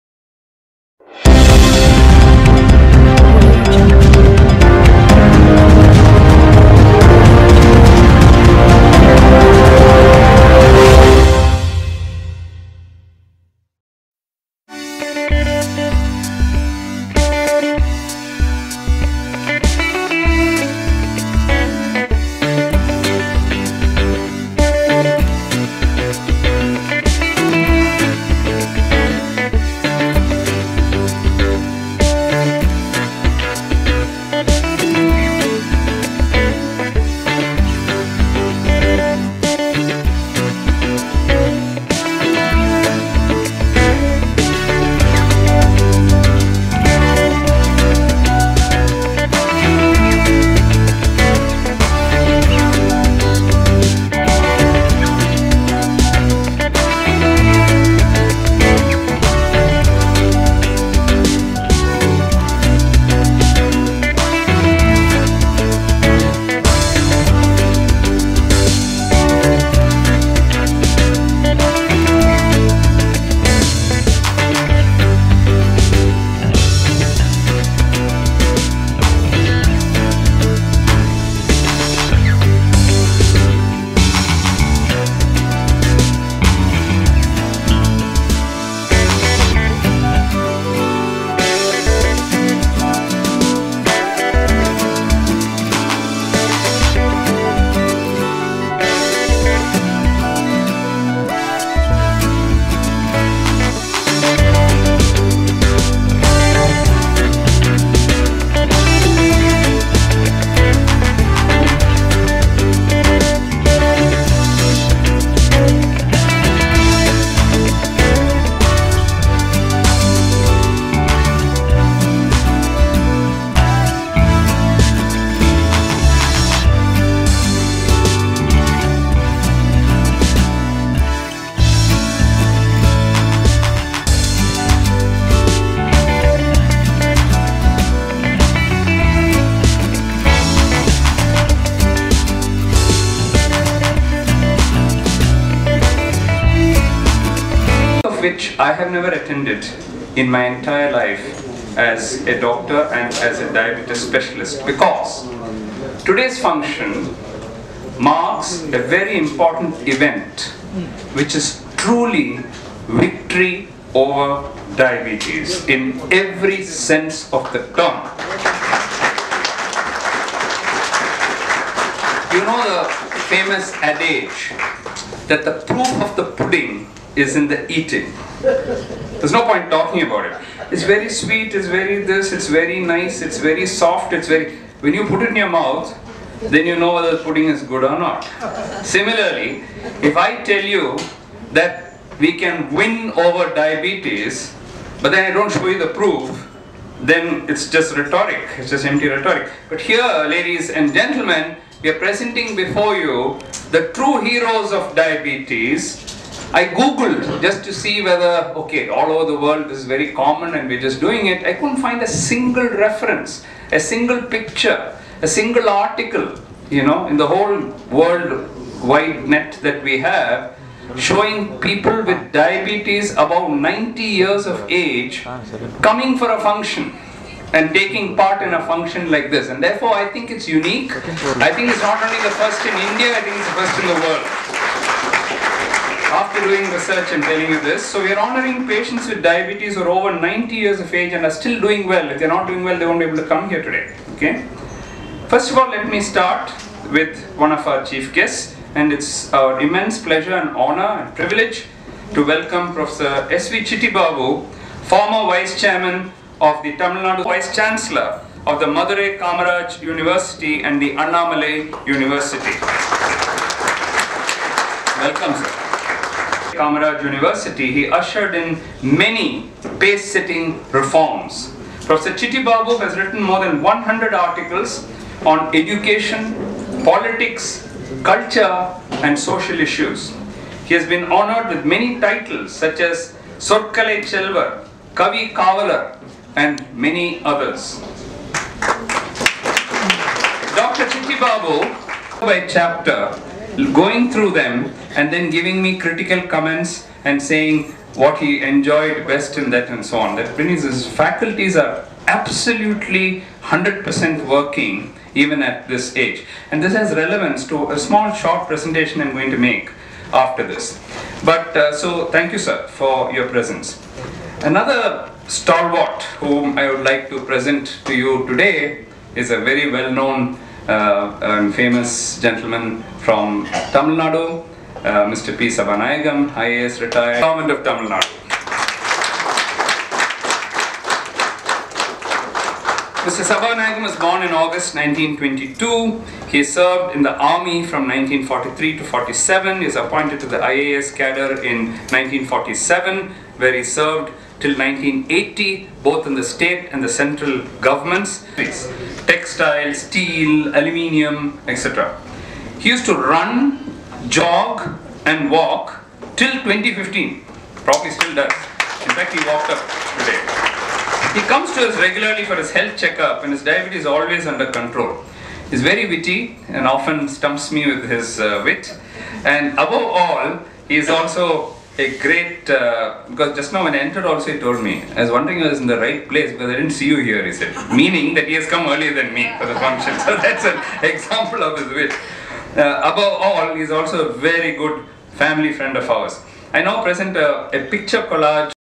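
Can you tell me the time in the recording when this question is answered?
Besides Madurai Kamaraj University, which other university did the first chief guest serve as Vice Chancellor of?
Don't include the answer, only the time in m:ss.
4:20.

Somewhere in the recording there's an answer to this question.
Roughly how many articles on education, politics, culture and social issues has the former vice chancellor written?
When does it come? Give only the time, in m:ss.
4:33.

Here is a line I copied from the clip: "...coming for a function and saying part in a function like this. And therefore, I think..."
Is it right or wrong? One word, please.
wrong.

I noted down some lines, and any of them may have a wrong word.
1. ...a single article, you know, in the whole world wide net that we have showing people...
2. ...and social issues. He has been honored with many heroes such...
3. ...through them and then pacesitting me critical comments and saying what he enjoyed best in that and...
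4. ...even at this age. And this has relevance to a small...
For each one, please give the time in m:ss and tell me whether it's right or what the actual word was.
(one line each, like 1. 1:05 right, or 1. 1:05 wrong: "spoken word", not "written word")
1. 3:35 right
2. 4:39 wrong: "titles", not "heroes"
3. 4:54 wrong: "giving", not "pacesitting"
4. 5:05 right.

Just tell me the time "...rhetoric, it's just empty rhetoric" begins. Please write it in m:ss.
3:17.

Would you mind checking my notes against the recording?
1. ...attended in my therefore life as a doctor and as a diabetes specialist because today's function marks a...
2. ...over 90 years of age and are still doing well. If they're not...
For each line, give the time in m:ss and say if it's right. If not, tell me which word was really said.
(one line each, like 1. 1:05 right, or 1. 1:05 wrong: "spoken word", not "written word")
1. 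2:29 wrong: "entire", not "therefore"
2. 3:59 right.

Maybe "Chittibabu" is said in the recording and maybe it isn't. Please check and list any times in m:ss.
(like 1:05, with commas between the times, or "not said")
4:13, 4:32, 4:50.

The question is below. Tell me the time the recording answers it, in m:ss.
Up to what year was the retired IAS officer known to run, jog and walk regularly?
5:56.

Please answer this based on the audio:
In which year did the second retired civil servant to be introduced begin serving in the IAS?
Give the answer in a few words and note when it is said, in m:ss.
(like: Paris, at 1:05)
1947, at 5:41.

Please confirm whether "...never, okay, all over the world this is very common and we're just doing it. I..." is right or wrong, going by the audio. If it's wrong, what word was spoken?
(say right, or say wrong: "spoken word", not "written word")
wrong: "whether", not "never".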